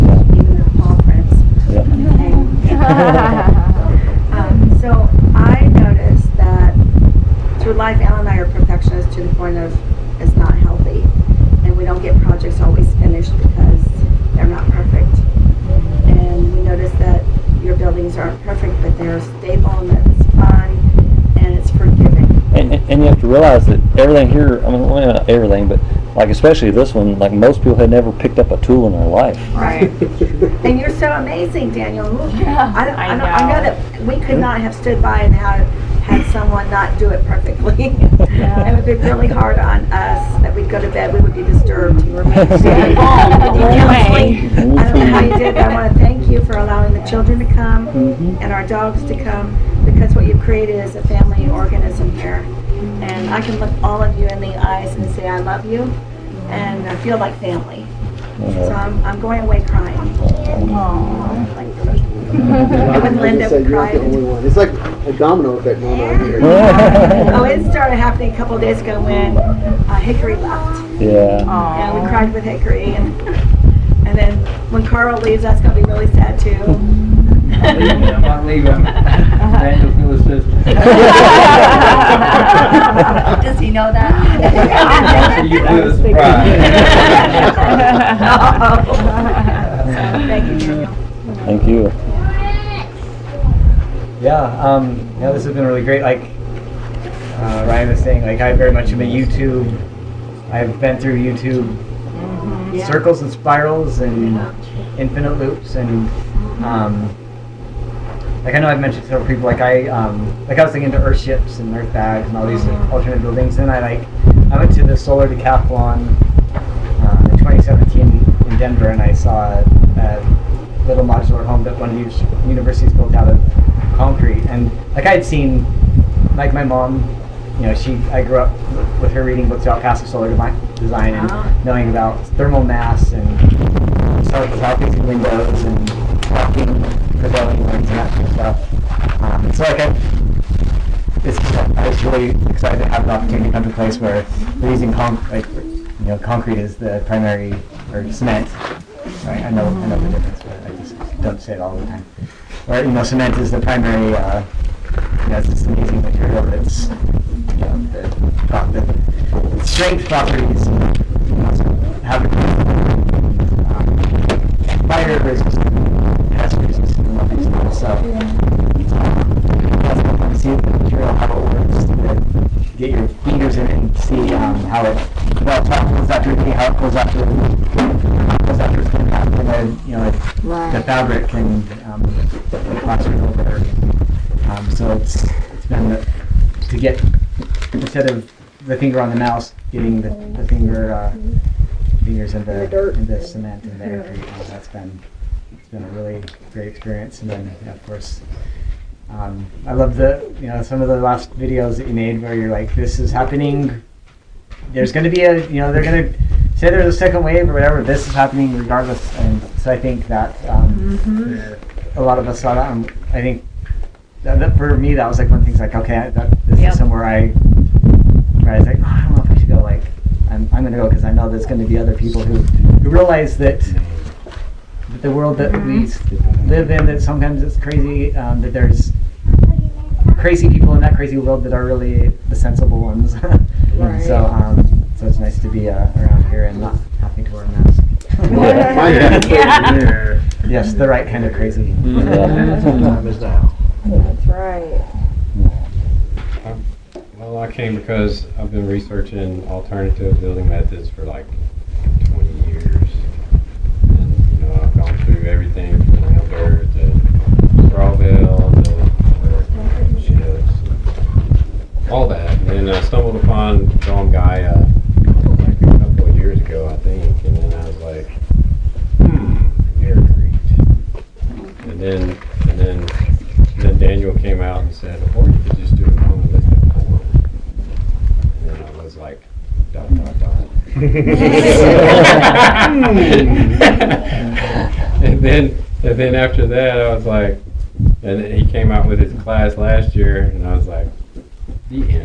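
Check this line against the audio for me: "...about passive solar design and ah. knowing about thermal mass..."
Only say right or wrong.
right.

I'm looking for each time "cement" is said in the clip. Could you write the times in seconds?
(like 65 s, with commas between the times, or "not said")
148 s, 153 s, 193 s.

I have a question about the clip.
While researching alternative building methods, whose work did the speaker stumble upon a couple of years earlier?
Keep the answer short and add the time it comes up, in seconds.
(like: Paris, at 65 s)
John Gaia, at 263 s.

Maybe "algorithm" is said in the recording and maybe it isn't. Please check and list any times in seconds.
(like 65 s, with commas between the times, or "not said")
not said.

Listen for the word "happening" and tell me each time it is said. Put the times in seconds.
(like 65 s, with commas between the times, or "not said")
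67 s, 203 s, 208 s.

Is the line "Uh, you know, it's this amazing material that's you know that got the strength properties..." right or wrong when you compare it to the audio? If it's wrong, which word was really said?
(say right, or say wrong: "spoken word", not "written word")
right.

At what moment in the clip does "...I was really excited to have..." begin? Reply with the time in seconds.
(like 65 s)
141 s.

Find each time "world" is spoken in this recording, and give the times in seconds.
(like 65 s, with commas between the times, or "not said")
225 s, 231 s.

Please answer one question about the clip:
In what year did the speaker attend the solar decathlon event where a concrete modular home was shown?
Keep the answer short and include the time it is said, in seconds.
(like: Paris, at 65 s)
2017, at 117 s.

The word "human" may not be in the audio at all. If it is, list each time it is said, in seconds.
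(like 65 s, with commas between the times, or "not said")
not said.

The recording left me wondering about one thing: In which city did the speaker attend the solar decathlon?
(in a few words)
Denver.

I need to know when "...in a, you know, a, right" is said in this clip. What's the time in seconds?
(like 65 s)
179 s.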